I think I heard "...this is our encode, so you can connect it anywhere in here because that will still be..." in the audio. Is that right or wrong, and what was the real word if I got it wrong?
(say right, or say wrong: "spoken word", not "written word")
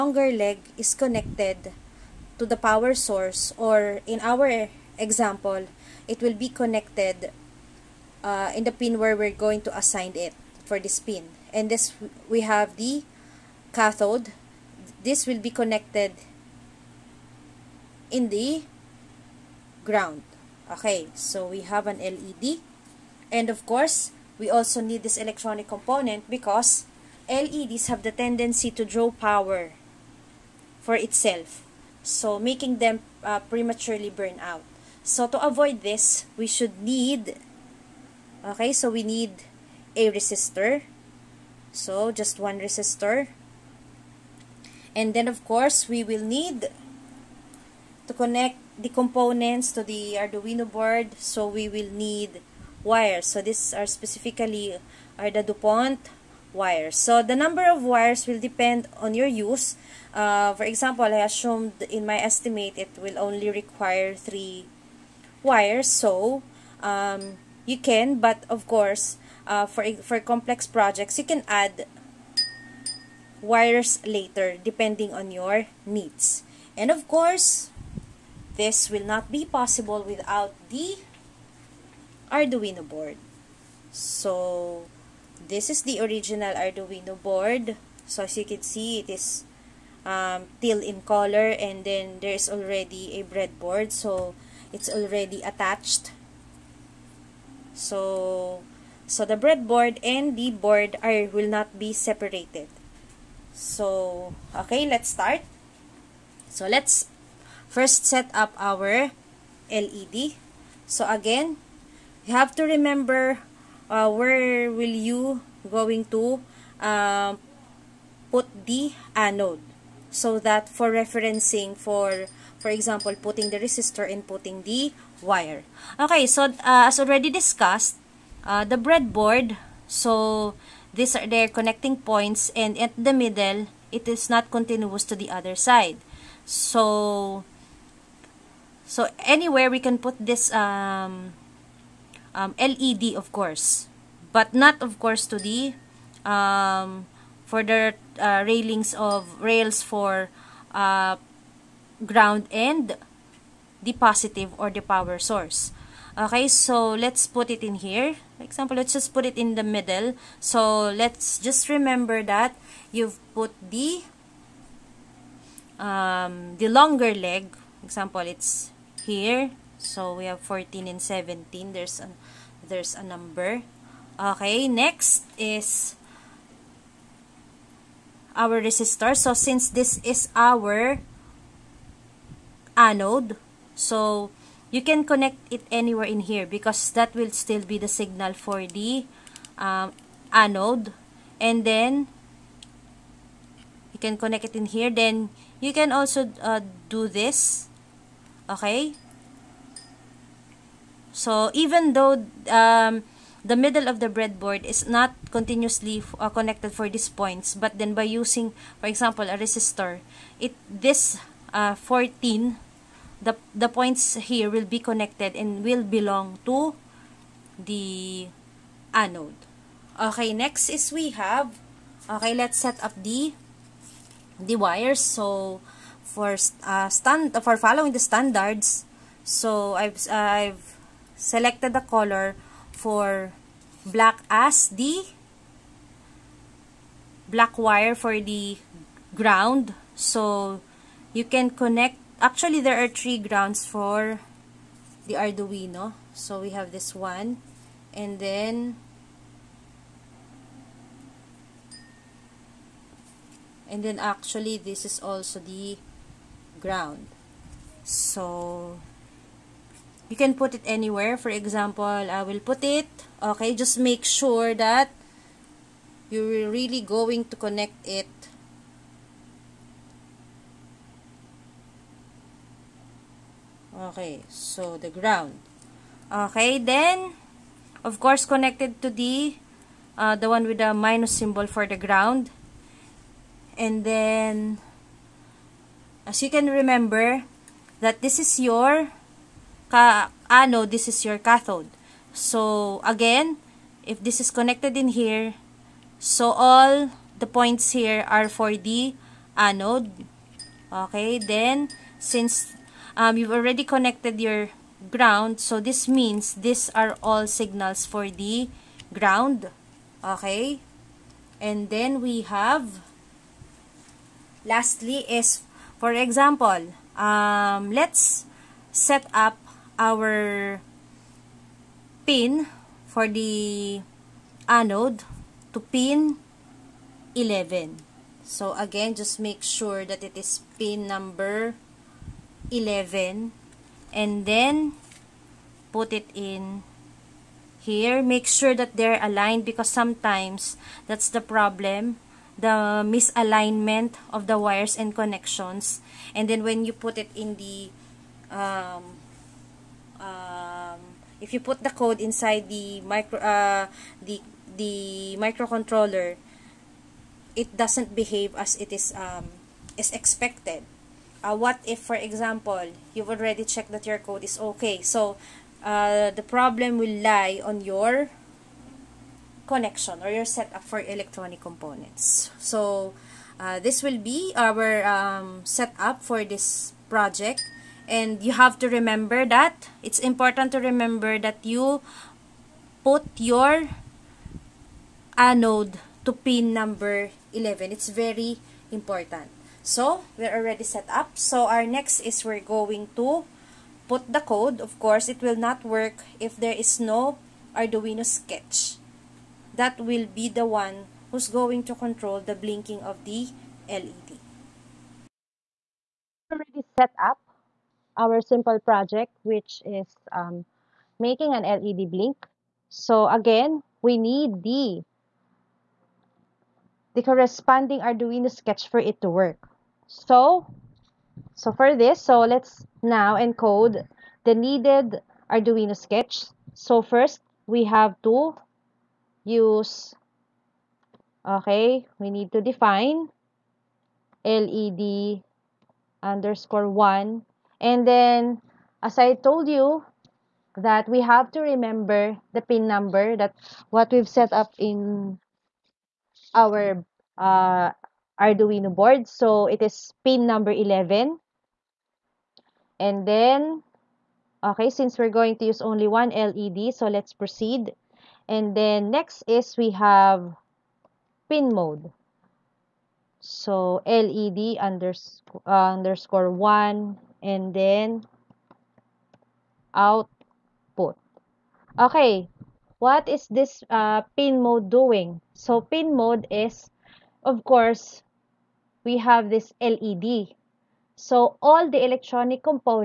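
wrong: "anode", not "encode".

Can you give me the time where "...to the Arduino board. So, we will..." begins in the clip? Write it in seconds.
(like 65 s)
49 s.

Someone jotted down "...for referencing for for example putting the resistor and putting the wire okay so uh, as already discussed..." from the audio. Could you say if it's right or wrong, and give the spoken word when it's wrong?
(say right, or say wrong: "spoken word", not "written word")
right.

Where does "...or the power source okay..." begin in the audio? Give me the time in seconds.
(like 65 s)
154 s.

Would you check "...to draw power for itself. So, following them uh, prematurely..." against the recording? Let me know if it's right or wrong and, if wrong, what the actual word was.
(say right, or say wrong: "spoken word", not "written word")
wrong: "making", not "following".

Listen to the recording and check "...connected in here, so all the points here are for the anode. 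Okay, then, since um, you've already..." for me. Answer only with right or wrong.
right.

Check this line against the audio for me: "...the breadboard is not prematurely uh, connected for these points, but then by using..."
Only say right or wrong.
wrong.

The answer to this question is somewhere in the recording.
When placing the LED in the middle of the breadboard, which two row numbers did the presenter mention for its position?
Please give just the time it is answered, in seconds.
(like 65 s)
170 s.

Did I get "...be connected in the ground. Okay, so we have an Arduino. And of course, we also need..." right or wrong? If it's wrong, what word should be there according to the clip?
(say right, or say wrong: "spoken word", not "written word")
wrong: "LED", not "Arduino".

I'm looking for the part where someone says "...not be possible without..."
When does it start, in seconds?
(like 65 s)
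79 s.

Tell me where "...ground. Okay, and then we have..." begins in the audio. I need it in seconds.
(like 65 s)
308 s.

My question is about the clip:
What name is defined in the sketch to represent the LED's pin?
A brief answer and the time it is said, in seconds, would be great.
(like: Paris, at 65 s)
LED_1, at 434 s.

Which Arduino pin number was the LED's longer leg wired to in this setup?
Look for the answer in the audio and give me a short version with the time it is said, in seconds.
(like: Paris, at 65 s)
11, at 325 s.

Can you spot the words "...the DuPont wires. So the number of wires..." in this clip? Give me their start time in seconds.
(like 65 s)
55 s.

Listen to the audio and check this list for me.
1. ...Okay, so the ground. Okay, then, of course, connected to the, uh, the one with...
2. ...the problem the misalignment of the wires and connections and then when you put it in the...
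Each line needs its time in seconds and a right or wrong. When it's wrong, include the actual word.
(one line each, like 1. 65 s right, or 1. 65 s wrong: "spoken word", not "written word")
1. 273 s right
2. 341 s right.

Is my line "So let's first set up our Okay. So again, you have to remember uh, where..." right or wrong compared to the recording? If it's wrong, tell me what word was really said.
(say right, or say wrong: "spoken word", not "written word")
wrong: "LED", not "Okay".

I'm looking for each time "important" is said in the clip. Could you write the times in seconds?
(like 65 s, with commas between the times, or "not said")
379 s, 388 s.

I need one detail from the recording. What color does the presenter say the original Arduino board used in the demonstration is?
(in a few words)
Teal.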